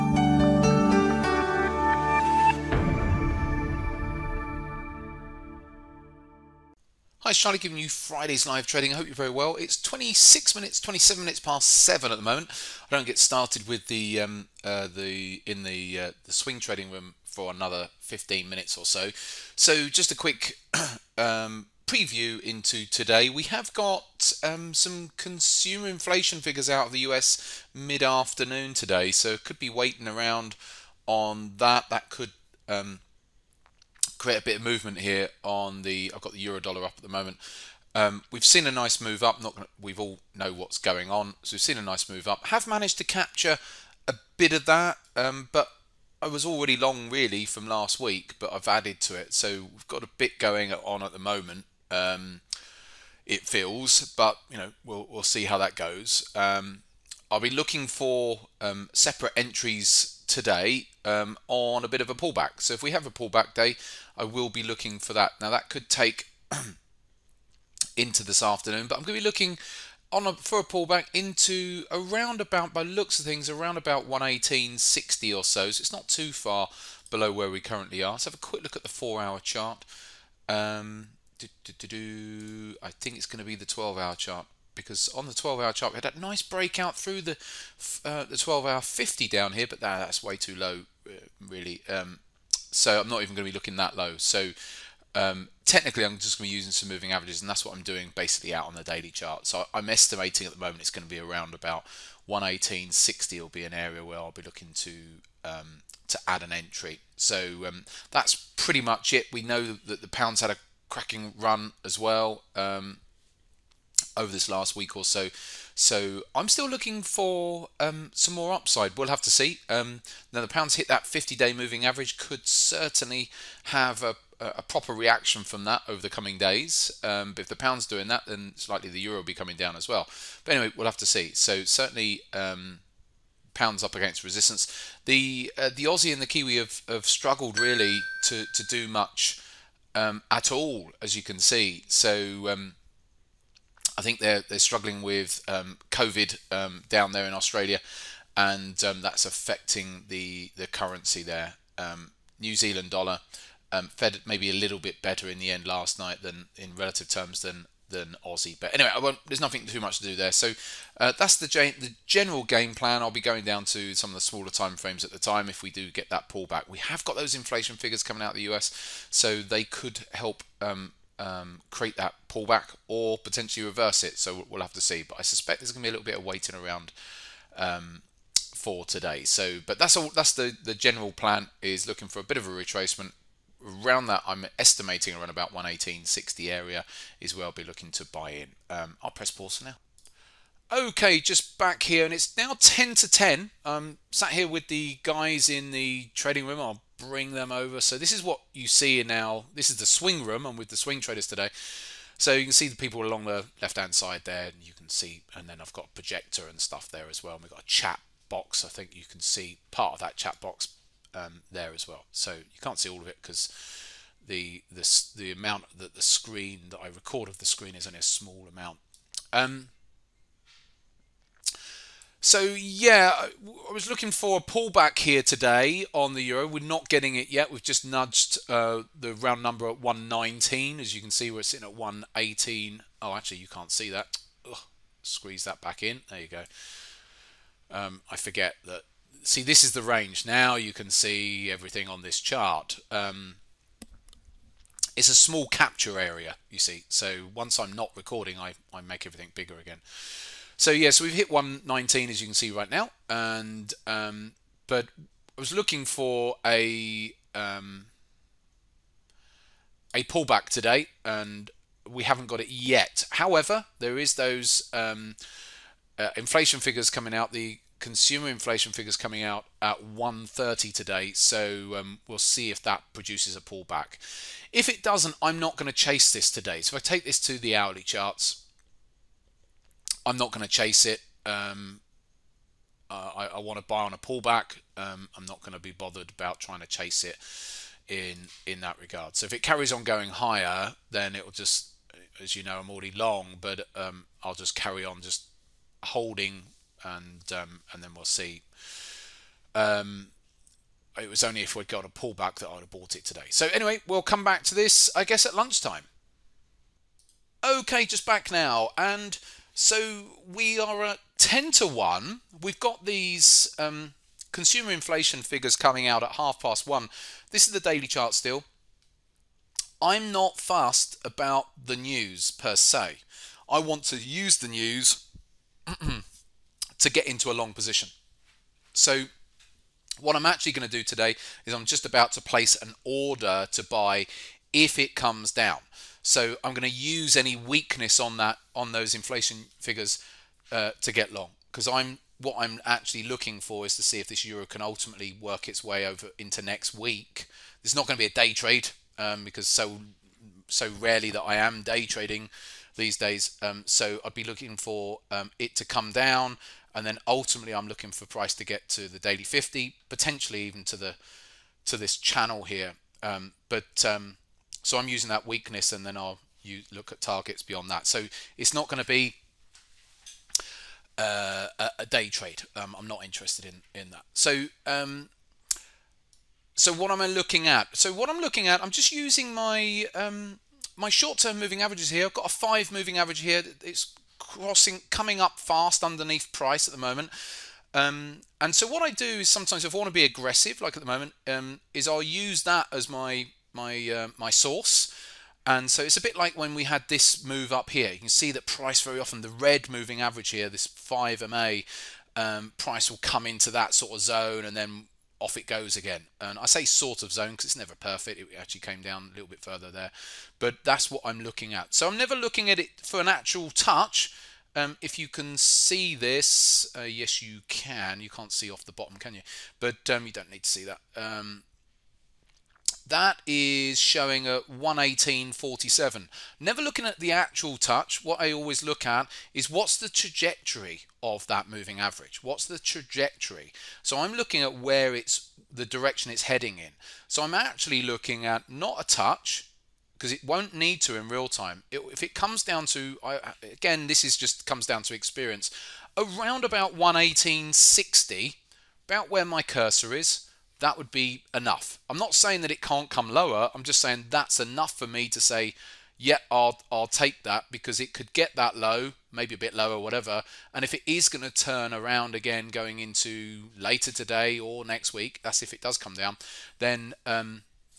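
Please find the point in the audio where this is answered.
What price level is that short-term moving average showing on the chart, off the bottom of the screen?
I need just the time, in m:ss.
7:04.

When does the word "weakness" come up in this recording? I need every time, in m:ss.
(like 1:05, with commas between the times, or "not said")
5:37, 6:05.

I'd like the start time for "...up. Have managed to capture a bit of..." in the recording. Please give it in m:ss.
0:42.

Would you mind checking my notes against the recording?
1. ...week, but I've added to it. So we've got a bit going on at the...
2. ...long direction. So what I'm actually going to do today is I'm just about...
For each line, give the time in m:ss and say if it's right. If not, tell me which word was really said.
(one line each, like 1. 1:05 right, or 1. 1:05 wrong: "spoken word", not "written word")
1. 0:47 right
2. 5:27 wrong: "position", not "direction".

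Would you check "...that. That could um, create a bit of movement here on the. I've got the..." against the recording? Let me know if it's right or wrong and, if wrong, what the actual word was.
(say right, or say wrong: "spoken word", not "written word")
right.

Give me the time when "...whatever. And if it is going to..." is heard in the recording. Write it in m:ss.
7:39.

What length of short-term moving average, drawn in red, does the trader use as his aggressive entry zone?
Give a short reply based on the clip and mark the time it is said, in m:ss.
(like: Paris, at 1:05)
5, at 6:22.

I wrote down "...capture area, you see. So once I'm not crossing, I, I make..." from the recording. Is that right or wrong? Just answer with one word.
wrong.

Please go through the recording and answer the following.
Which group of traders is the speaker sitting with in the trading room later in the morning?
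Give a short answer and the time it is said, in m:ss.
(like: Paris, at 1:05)
swing traders, at 3:20.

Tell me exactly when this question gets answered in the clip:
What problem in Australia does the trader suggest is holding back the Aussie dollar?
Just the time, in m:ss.
2:25.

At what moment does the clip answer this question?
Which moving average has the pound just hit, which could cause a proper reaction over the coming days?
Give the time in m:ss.
2:01.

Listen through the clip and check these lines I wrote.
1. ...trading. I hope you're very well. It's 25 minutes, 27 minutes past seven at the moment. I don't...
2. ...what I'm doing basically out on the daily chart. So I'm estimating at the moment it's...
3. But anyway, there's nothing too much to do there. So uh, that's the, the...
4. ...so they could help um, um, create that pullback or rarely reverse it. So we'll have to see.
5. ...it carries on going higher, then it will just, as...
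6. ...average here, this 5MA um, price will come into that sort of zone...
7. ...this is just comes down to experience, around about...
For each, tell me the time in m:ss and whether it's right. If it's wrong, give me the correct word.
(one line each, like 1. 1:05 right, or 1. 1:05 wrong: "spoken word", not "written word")
1. 0:08 wrong: "26", not "25"
2. 1:37 right
3. 2:38 right
4. 2:49 wrong: "potentially", not "rarely"
5. 4:49 right
6. 6:39 right
7. 7:23 right.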